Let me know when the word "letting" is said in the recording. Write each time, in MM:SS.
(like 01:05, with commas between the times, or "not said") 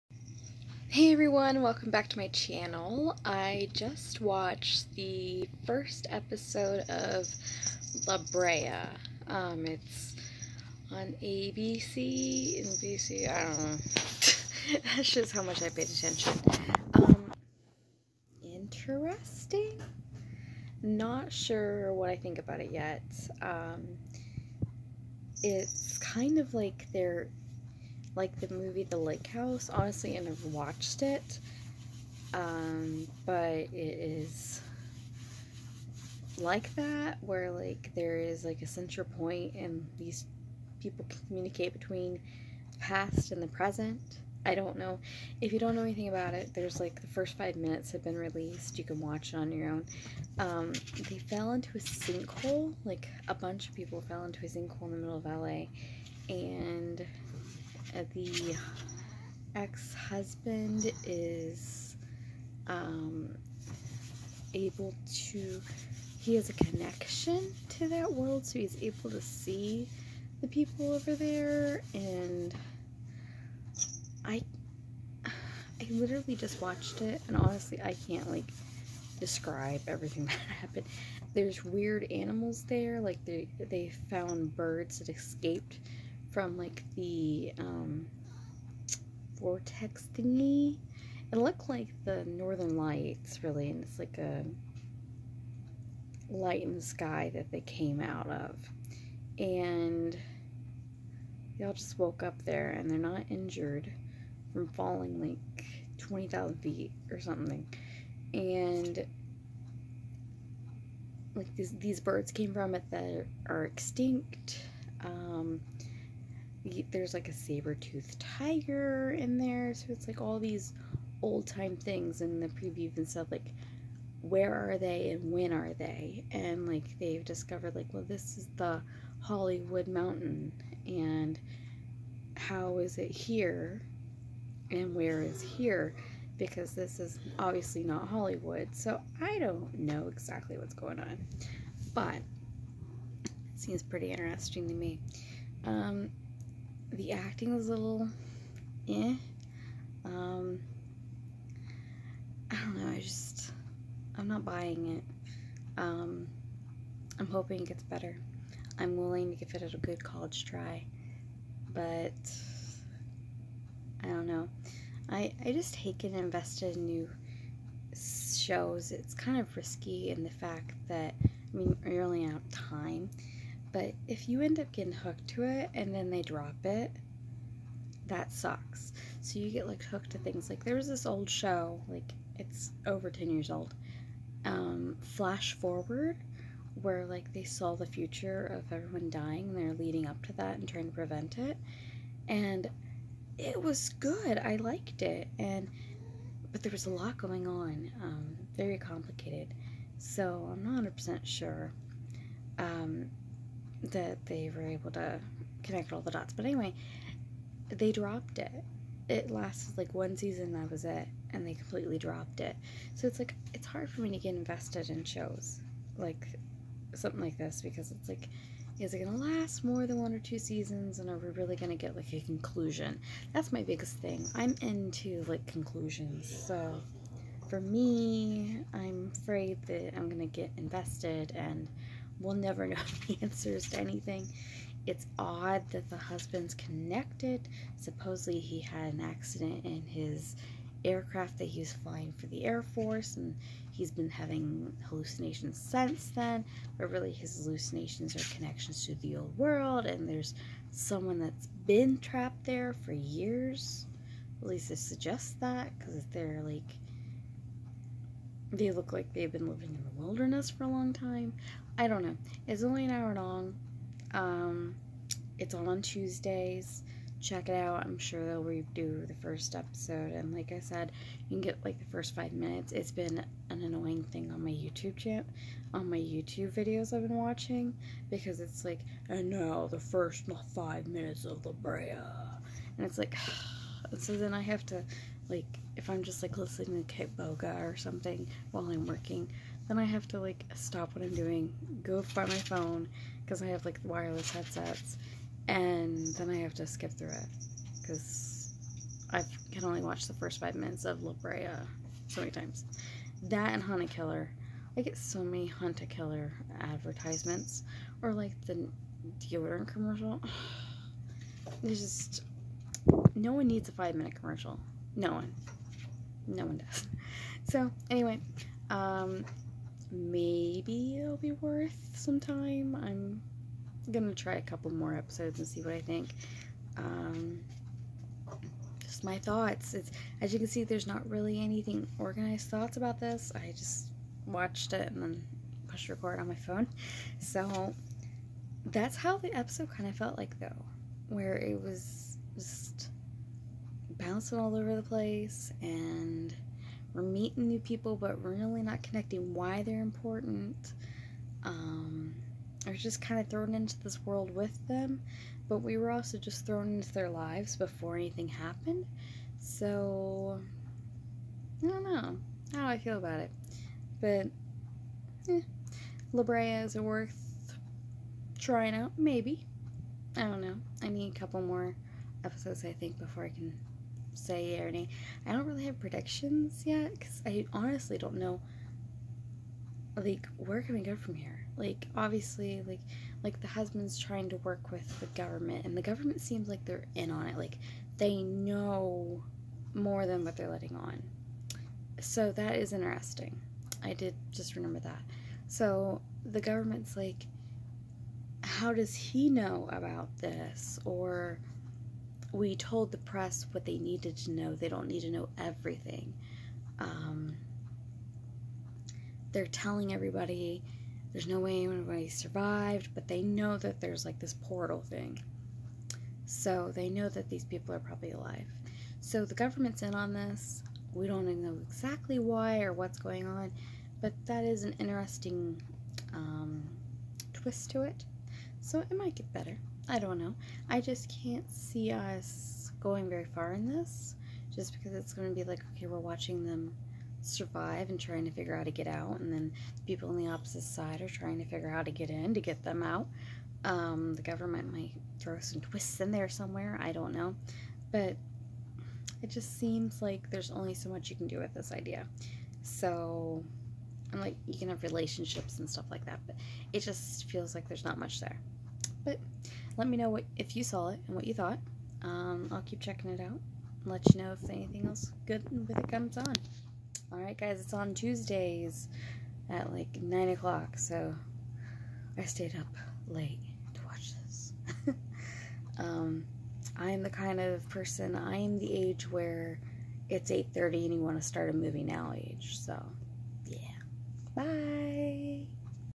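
06:30.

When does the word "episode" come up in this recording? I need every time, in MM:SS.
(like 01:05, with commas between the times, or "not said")
00:06, 04:29, 05:24, 05:39, 06:12.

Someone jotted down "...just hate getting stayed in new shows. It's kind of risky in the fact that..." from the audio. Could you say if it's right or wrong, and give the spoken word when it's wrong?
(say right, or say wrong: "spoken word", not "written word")
wrong: "invested", not "stayed".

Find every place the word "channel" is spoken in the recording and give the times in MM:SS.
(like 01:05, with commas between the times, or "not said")
00:02, 04:34.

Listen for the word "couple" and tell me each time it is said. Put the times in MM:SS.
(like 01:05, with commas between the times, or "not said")
05:24, 06:11.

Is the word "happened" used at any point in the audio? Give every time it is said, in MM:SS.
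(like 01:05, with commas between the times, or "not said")
01:20, 05:58.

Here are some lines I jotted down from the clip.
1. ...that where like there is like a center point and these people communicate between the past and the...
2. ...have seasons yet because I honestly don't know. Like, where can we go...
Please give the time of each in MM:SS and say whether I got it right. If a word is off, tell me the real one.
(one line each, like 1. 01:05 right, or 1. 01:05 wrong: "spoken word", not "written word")
1. 00:36 right
2. 06:15 wrong: "predictions", not "seasons".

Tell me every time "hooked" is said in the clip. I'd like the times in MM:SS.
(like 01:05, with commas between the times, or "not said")
02:54, 02:59.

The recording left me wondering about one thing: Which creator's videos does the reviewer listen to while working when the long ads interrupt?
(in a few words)
Kitboga.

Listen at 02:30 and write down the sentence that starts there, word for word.
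Um, I don't know, I just, I'm not buying it.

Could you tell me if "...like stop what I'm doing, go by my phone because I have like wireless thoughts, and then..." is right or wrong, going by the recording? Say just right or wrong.
wrong.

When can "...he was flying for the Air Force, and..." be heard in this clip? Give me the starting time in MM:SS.
04:01.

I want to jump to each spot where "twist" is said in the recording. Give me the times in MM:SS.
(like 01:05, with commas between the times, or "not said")
07:07, 07:25.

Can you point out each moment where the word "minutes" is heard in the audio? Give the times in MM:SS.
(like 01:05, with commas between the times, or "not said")
00:47, 04:32, 04:40, 05:00, 05:13.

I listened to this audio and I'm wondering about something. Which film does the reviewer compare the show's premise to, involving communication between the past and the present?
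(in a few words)
The Lake House.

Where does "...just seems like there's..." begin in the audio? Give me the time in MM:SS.
07:29.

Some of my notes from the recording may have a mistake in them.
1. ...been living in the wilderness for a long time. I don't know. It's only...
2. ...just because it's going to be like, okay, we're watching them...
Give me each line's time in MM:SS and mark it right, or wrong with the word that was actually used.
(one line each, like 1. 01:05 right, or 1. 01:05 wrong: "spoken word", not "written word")
1. 04:19 right
2. 07:14 right.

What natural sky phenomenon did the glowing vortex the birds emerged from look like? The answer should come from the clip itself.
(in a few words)
The northern lights.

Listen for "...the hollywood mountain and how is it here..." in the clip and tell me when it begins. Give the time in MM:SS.
02:08.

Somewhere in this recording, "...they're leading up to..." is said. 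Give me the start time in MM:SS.
03:09.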